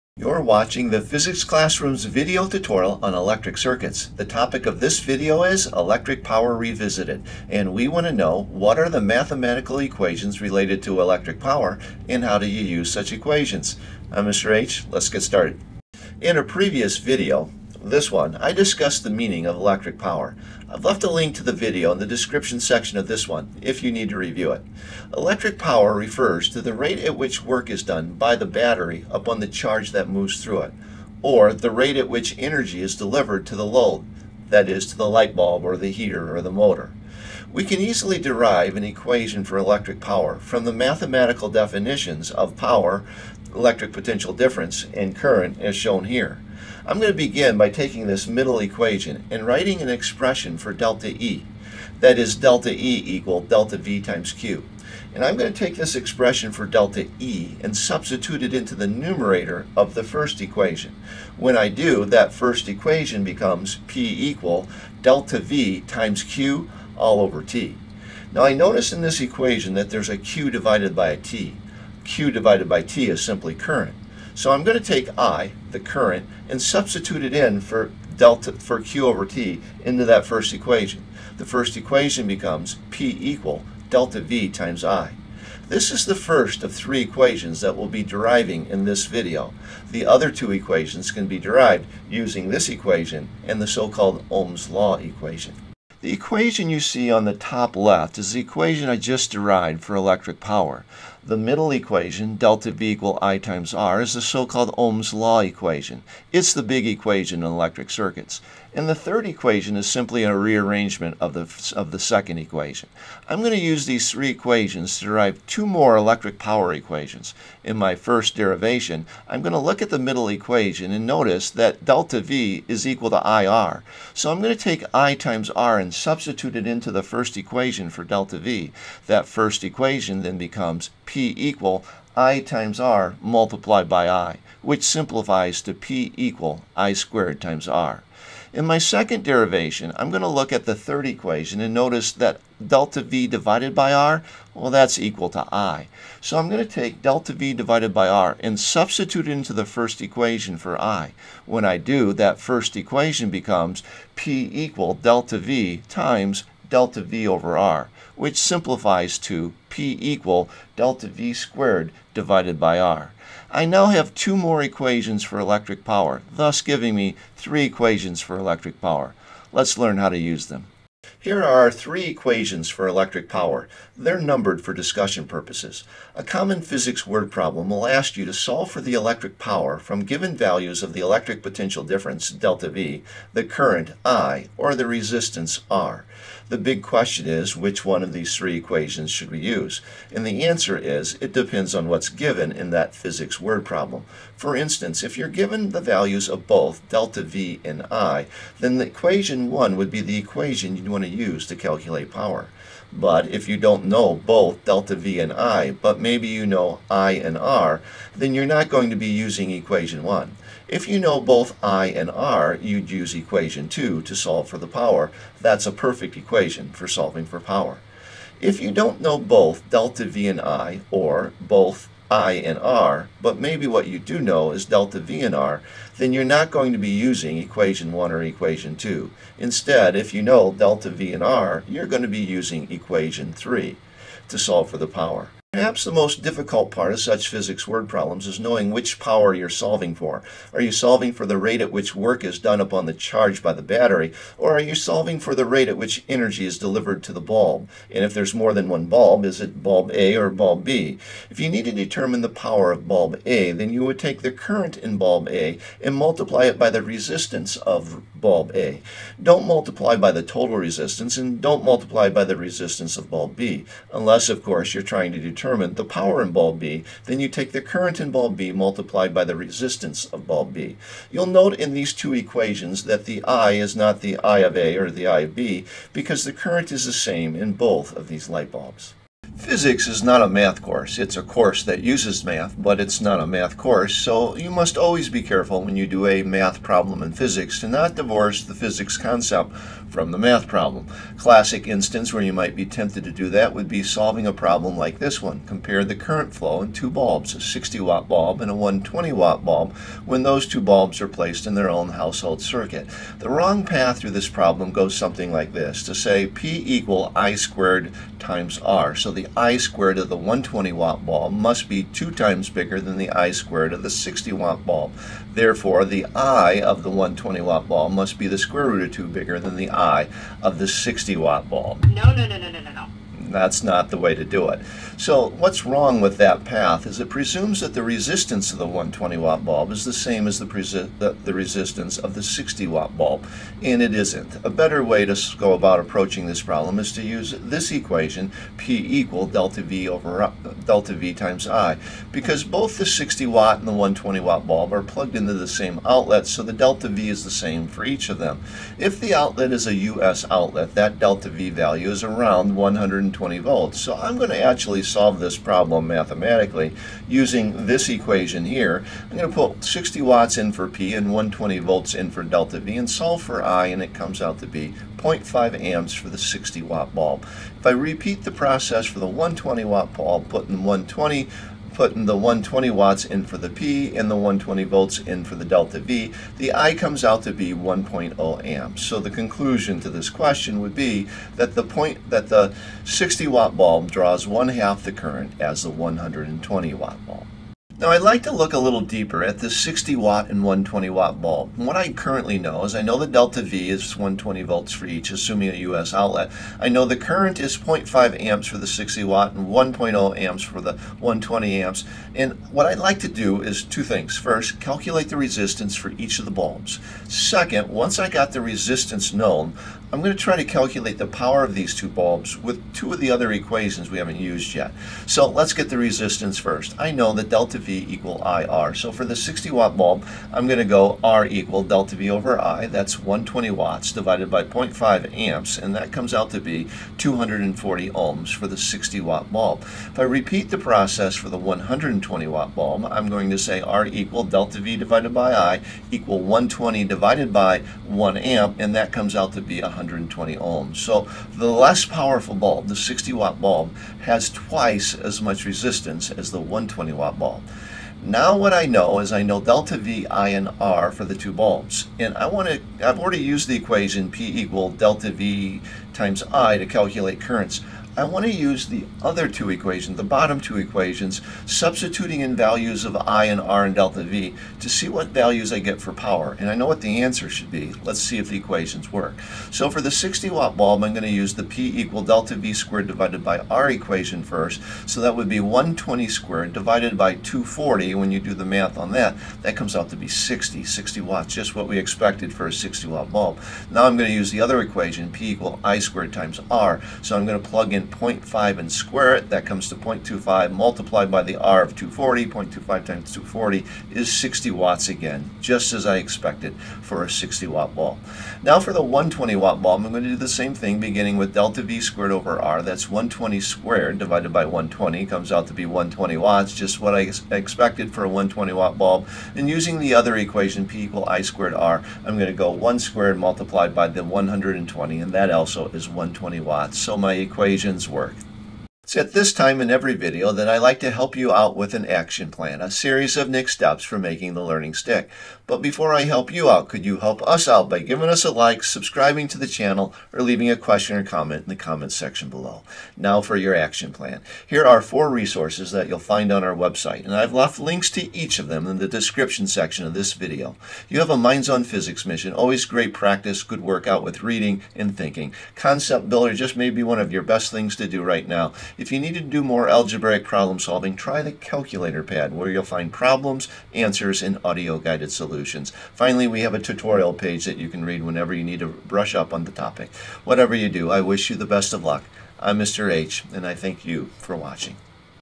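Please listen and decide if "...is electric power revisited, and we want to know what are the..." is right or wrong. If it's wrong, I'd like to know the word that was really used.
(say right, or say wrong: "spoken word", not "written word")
right.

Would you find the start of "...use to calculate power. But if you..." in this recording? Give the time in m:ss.
3:21.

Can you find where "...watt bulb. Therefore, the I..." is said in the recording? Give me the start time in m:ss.
5:14.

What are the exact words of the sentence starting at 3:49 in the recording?
Instead, if you know delta V and R, you're going to be using equation 3 to solve for the power.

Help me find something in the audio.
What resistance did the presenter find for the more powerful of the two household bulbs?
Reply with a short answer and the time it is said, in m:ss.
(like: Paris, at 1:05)
120 ohms, at 7:19.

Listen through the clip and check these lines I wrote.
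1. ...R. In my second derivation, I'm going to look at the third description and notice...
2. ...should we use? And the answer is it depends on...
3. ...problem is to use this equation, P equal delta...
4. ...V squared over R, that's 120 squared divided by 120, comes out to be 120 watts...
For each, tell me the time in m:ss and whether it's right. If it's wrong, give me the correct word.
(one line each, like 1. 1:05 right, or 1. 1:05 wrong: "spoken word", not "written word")
1. 2:17 wrong: "equation", not "description"
2. 3:09 right
3. 5:36 right
4. 8:21 right.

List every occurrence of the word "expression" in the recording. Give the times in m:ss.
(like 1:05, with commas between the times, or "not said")
0:49, 0:55.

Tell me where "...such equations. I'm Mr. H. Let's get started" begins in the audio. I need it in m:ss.
0:12.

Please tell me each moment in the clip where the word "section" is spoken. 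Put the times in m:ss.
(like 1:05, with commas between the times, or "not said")
0:22, 8:51, 8:59.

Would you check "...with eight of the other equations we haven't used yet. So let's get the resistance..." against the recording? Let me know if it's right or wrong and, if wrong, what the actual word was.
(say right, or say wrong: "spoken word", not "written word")
wrong: "two", not "eight".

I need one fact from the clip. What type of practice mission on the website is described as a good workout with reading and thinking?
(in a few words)
Minds on Physics.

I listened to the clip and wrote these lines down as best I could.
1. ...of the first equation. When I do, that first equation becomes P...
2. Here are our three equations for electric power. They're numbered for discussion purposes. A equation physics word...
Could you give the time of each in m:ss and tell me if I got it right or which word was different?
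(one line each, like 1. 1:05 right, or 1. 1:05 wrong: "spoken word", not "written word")
1. 0:59 right
2. 2:51 wrong: "common", not "equation".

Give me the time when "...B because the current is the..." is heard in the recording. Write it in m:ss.
4:35.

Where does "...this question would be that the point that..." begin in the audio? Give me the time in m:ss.
6:19.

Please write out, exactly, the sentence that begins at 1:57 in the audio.
In my first derivation, I'm going to look at the middle equation and notice that delta V is equal to IR.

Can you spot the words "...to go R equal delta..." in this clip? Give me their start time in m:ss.
7:00.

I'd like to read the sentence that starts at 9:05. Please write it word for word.
Concept Builder just may be one of your best things to do right now.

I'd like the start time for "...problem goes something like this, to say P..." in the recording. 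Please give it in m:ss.
5:04.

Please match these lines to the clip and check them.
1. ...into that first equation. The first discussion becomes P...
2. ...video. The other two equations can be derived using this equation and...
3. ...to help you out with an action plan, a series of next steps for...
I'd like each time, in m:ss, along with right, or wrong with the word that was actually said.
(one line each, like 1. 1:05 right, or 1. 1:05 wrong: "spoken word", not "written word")
1. 1:19 wrong: "equation", not "discussion"
2. 1:29 right
3. 8:40 right.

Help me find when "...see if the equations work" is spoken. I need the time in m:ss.
7:47.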